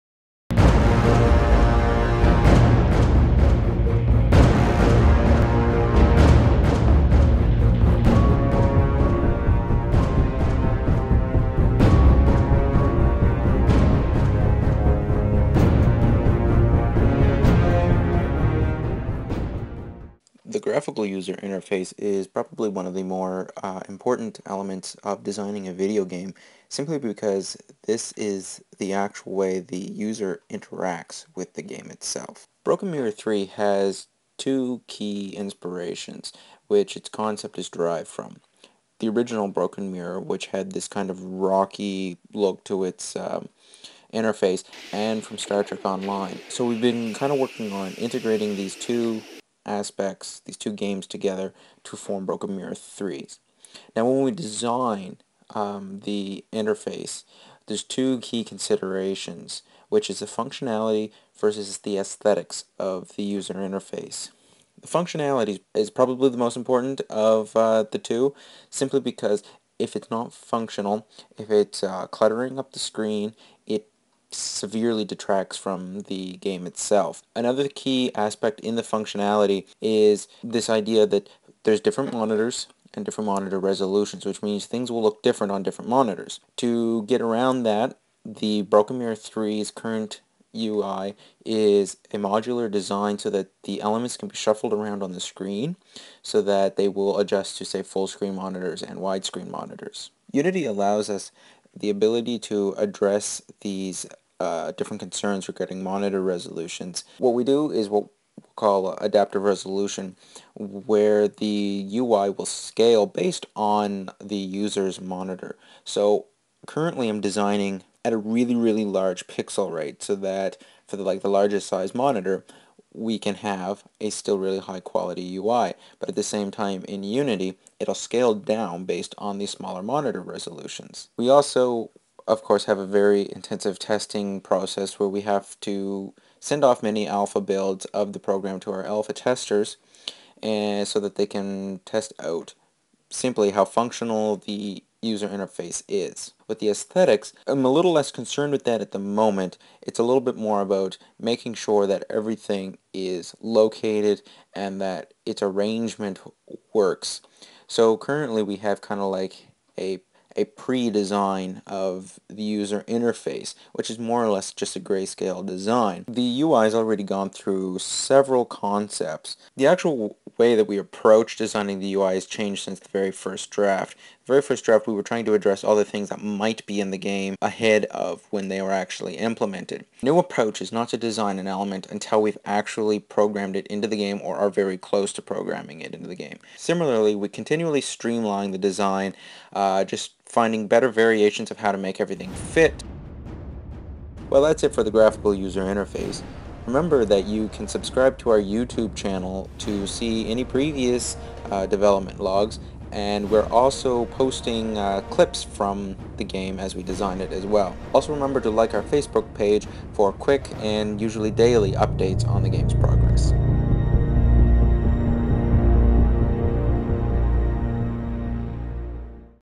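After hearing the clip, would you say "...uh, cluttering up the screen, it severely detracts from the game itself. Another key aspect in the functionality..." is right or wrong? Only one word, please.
right.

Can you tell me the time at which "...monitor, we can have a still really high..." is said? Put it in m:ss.
2:01.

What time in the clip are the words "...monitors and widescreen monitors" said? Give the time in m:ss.
1:38.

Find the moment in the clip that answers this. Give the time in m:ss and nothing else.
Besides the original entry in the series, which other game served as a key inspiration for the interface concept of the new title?
0:45.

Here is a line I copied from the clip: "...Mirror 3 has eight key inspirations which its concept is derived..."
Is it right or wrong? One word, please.
wrong.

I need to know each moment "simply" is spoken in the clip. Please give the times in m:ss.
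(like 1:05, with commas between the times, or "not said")
0:26, 1:08, 2:23.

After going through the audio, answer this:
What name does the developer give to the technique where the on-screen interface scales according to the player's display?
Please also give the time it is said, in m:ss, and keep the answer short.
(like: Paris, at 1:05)
adaptive resolution, at 1:48.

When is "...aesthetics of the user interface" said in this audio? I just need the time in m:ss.
1:01.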